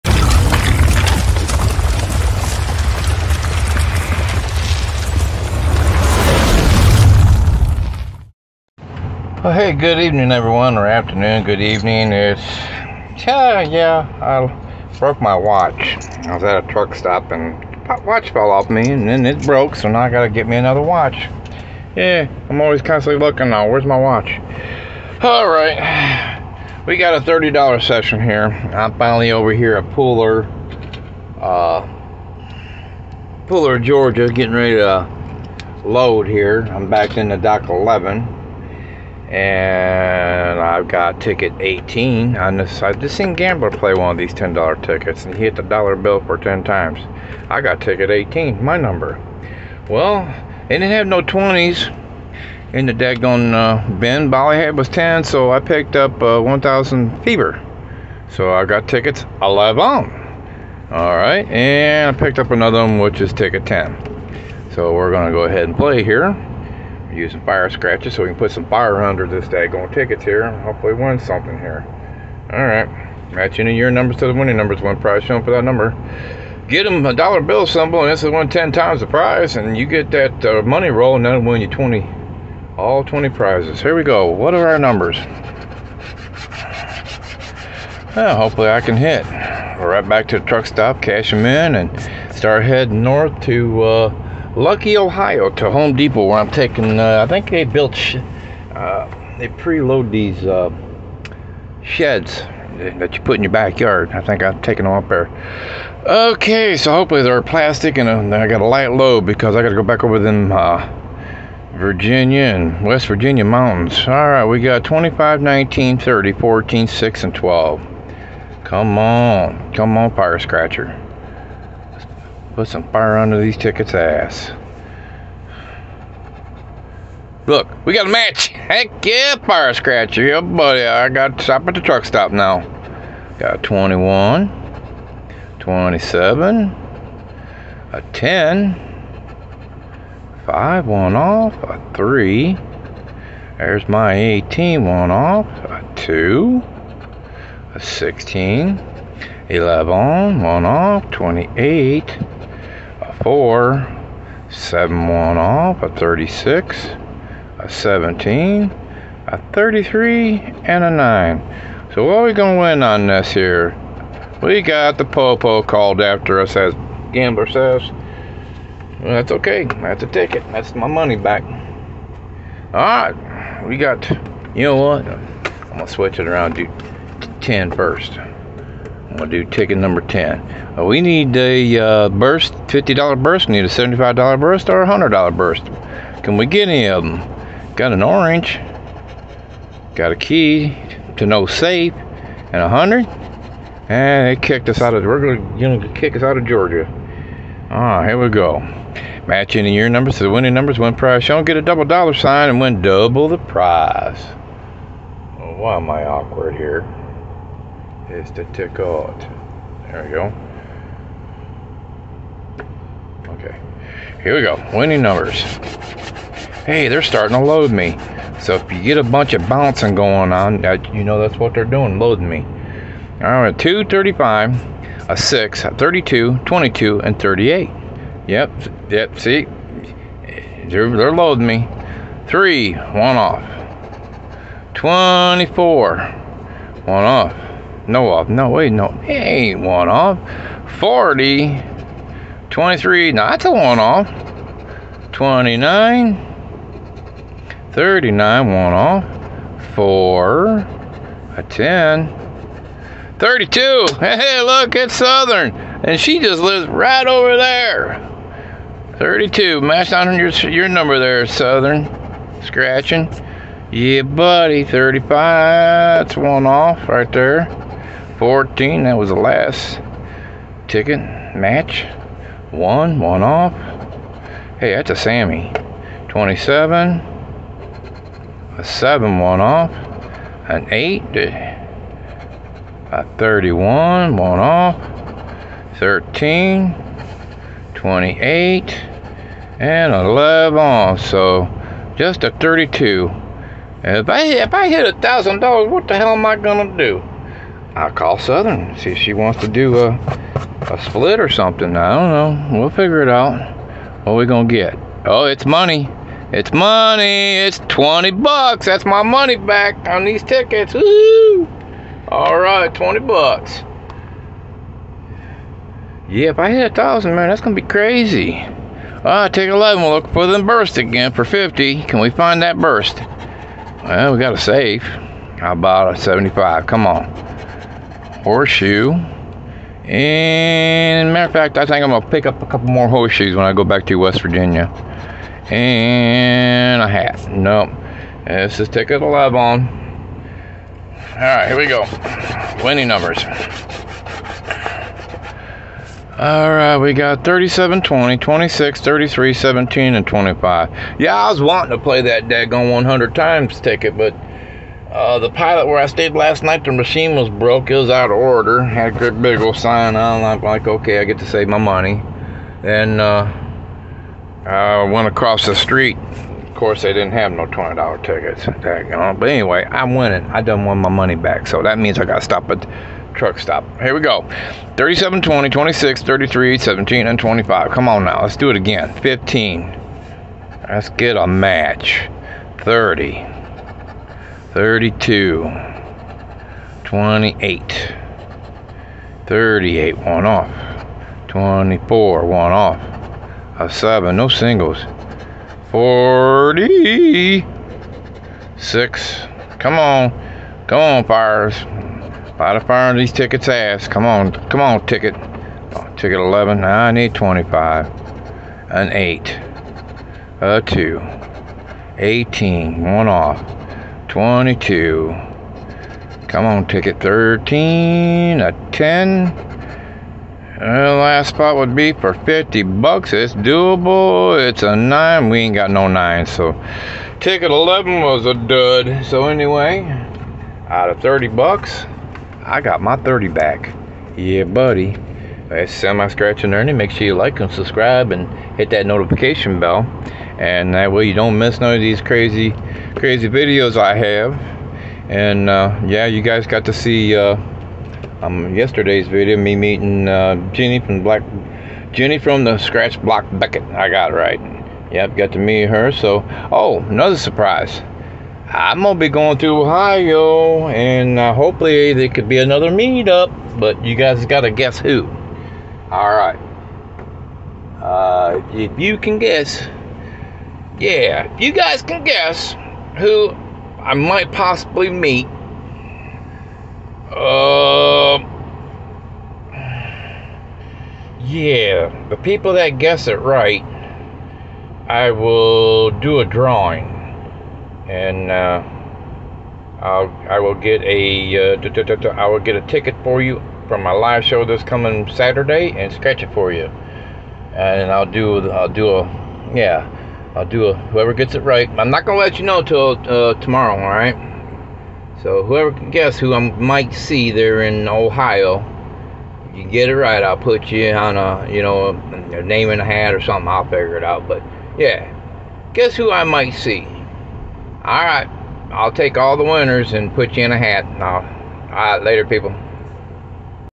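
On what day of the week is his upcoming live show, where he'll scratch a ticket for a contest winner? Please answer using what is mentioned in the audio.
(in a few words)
Saturday.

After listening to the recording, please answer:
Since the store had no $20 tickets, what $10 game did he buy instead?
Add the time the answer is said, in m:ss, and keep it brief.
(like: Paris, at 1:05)
1,000 Fever, at 0:56.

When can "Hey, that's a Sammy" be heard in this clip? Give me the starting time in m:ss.
4:34.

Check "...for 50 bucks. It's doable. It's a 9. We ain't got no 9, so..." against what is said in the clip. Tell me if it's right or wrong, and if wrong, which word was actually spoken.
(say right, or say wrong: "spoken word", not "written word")
right.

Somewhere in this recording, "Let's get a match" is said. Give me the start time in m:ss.
6:20.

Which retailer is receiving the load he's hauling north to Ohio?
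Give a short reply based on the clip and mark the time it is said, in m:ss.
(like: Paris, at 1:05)
Home Depot, at 1:35.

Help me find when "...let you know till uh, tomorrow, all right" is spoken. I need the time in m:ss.
8:22.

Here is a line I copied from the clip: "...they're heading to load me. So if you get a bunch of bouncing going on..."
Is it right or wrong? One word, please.
wrong.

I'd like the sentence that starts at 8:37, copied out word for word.
All right, I'll take all the winners and put you in a hat.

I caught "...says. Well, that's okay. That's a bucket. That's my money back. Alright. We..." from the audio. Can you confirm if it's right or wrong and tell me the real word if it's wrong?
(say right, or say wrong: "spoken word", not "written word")
wrong: "ticket", not "bucket".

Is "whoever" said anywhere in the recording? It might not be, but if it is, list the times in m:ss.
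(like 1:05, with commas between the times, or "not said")
8:20, 8:25.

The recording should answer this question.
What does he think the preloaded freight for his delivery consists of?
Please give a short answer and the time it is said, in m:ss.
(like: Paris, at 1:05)
Sheds, at 1:41.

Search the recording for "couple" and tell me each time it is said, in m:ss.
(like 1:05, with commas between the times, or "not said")
5:32.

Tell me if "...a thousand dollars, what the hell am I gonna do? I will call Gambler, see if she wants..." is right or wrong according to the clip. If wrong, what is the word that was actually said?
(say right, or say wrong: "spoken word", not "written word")
wrong: "Southern", not "Gambler".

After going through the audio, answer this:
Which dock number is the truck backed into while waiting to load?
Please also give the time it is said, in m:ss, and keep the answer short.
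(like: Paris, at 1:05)
11, at 0:37.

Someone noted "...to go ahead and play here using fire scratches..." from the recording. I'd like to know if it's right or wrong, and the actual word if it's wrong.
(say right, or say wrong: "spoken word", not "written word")
right.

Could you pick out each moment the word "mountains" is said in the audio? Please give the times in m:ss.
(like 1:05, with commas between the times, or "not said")
1:53.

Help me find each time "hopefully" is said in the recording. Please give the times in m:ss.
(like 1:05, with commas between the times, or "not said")
1:10, 1:28, 1:46, 7:41.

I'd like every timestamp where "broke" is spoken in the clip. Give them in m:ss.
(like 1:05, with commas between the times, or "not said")
0:14, 0:19, 5:57.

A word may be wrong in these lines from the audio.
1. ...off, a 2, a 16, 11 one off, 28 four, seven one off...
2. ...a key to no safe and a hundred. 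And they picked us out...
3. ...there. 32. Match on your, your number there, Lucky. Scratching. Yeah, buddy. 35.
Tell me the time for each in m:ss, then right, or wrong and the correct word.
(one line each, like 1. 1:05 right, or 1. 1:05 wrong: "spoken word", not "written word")
1. 2:25 right
2. 3:10 wrong: "kicked", not "picked"
3. 4:17 wrong: "Southern", not "Lucky".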